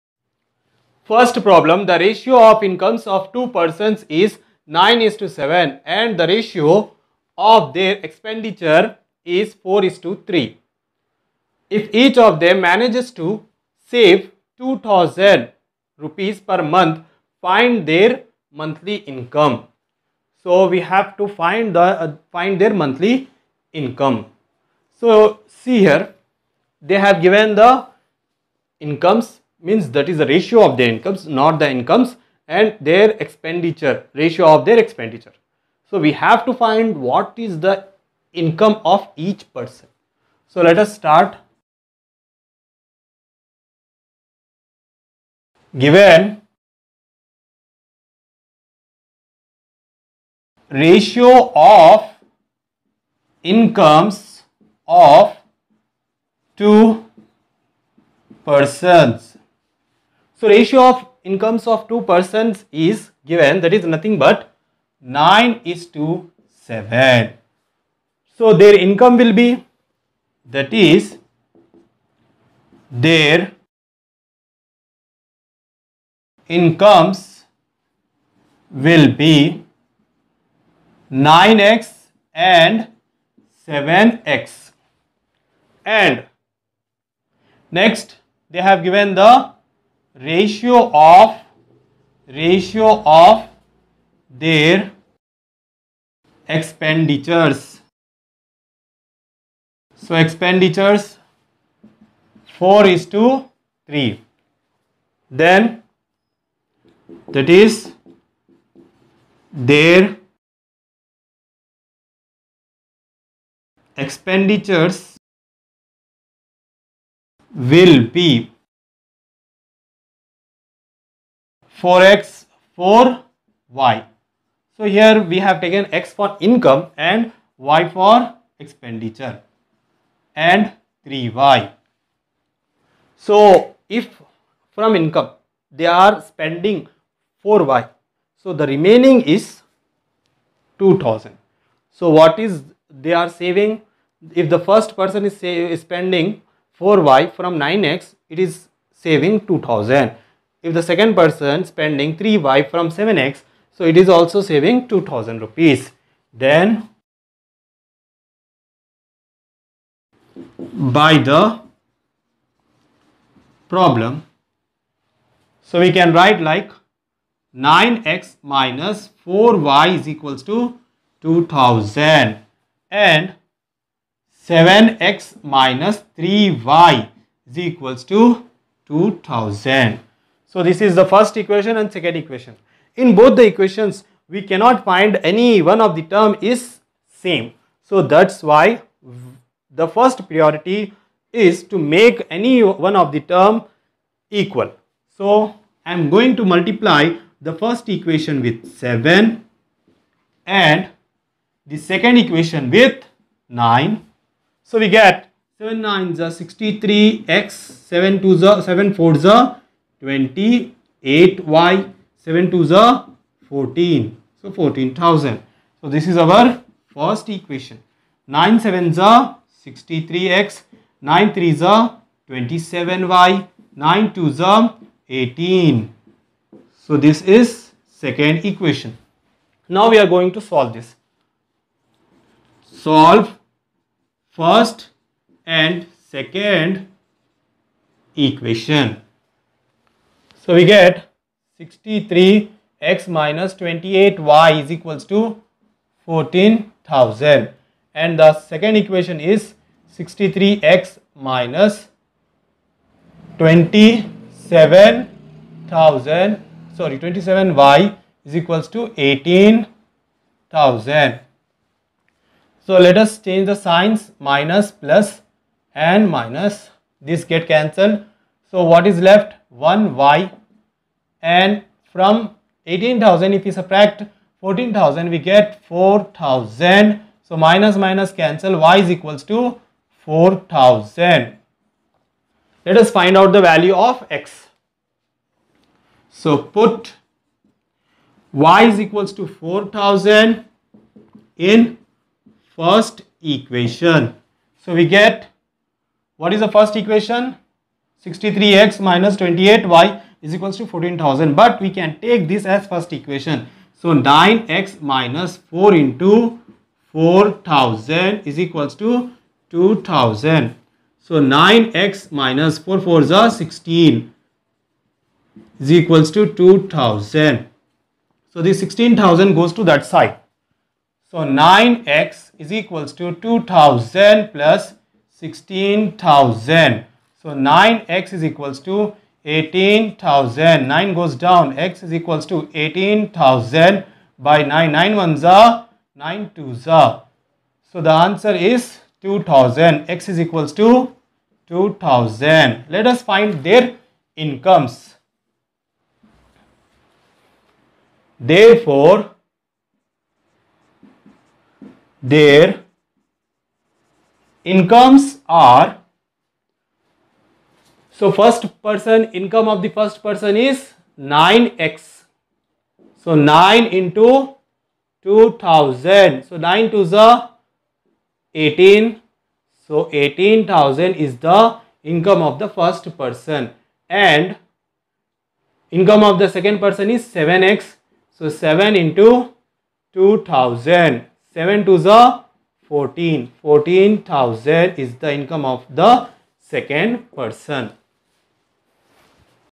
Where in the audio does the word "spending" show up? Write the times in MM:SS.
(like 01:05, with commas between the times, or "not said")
02:16, 02:25, 02:31.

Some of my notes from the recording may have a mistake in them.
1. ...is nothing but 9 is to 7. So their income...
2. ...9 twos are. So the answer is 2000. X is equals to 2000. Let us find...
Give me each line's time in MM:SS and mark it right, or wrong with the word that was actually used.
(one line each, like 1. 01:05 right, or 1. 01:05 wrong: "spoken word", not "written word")
1. 01:03 right
2. 05:35 right.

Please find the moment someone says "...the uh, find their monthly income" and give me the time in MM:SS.
00:21.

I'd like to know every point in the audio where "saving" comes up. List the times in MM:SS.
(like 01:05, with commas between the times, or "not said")
02:23, 02:29, 02:34.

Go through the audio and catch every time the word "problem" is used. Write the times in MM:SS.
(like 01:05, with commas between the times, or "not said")
00:01, 02:43.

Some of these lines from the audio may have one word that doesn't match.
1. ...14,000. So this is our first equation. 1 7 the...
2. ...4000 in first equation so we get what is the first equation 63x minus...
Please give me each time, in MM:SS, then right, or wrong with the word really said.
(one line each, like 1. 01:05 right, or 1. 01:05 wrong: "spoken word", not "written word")
1. 03:34 wrong: "9", not "1"
2. 04:49 right.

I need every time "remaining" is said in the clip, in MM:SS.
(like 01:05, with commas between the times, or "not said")
02:18.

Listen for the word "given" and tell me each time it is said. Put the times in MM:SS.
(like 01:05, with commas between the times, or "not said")
00:27, 00:45, 01:03, 01:28.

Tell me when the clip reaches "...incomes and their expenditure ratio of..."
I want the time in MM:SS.
00:31.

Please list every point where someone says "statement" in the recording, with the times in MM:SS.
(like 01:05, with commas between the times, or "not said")
not said.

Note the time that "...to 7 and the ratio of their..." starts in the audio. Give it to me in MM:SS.
00:05.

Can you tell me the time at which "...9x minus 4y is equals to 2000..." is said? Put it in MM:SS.
02:47.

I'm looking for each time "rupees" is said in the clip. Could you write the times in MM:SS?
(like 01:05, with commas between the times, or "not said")
00:15, 02:35.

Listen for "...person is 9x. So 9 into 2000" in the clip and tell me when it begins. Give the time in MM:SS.
06:00.